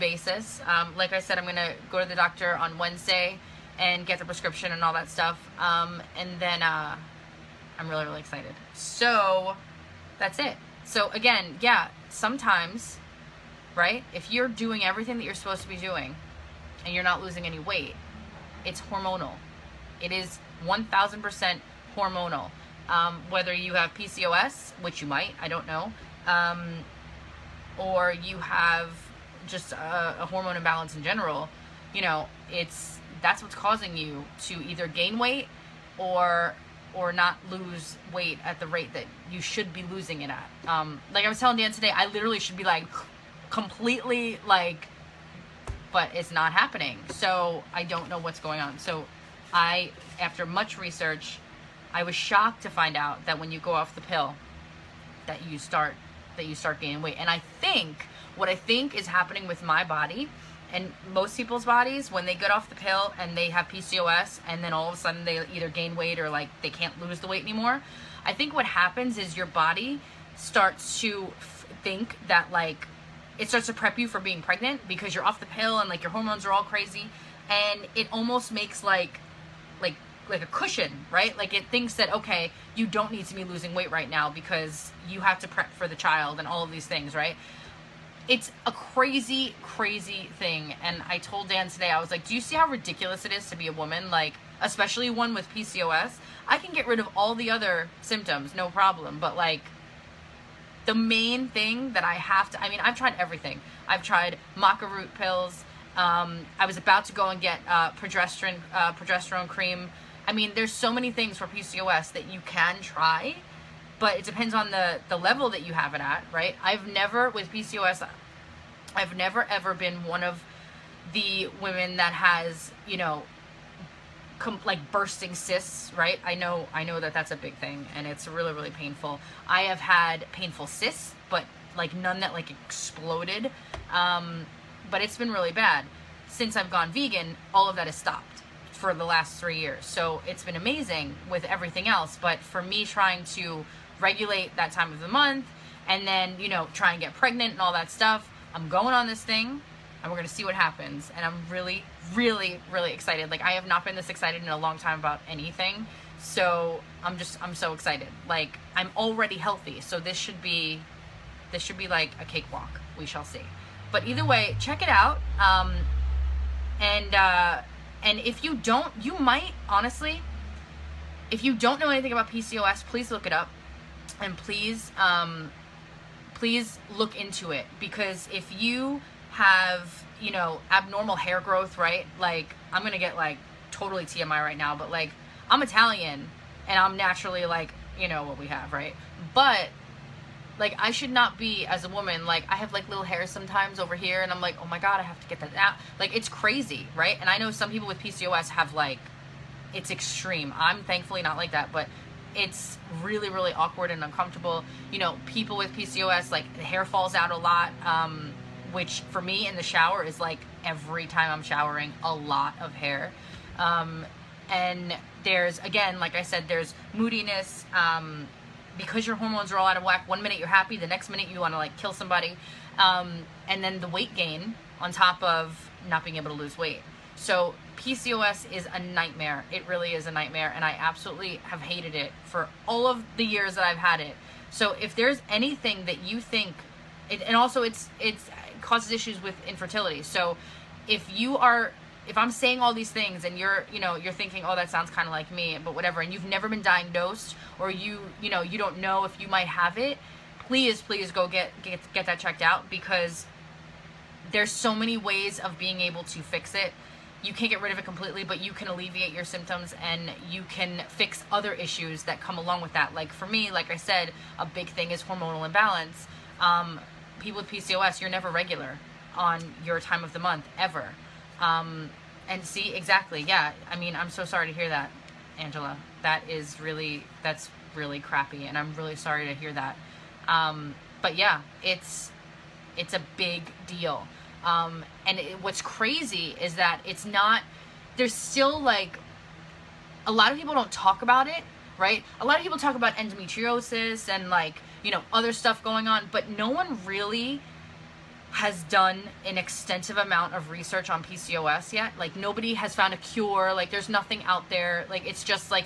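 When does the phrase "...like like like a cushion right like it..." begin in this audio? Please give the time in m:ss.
1:18.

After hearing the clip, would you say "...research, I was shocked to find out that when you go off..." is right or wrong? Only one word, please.
right.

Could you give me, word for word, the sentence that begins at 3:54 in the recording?
So if there's anything that you think, it, and also it's, it's, causes issues with infertility.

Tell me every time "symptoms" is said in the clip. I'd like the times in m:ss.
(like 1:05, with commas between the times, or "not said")
1:37, 4:19.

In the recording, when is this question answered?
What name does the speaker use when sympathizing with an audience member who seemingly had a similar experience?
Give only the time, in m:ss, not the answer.
4:35.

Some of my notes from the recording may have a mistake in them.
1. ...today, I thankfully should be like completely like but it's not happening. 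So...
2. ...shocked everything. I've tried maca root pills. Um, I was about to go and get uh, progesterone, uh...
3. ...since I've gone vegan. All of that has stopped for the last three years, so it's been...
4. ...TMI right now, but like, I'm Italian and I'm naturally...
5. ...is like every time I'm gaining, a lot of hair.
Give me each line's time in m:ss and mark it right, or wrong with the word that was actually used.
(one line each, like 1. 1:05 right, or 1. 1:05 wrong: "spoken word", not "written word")
1. 0:41 wrong: "literally", not "thankfully"
2. 1:42 wrong: "tried", not "shocked"
3. 2:16 right
4. 3:04 right
5. 3:30 wrong: "showering", not "gaining".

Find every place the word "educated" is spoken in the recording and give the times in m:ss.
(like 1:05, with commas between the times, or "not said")
not said.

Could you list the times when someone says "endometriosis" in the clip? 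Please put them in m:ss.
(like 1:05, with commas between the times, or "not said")
4:52.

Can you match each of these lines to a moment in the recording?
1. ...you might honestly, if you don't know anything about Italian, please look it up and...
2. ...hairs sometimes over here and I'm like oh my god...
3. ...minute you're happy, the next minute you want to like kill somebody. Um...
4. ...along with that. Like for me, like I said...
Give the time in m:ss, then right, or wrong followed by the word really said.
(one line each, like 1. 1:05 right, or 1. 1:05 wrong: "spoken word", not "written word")
1. 2:48 wrong: "PCOS", not "Italian"
2. 3:13 right
3. 3:40 right
4. 4:22 right.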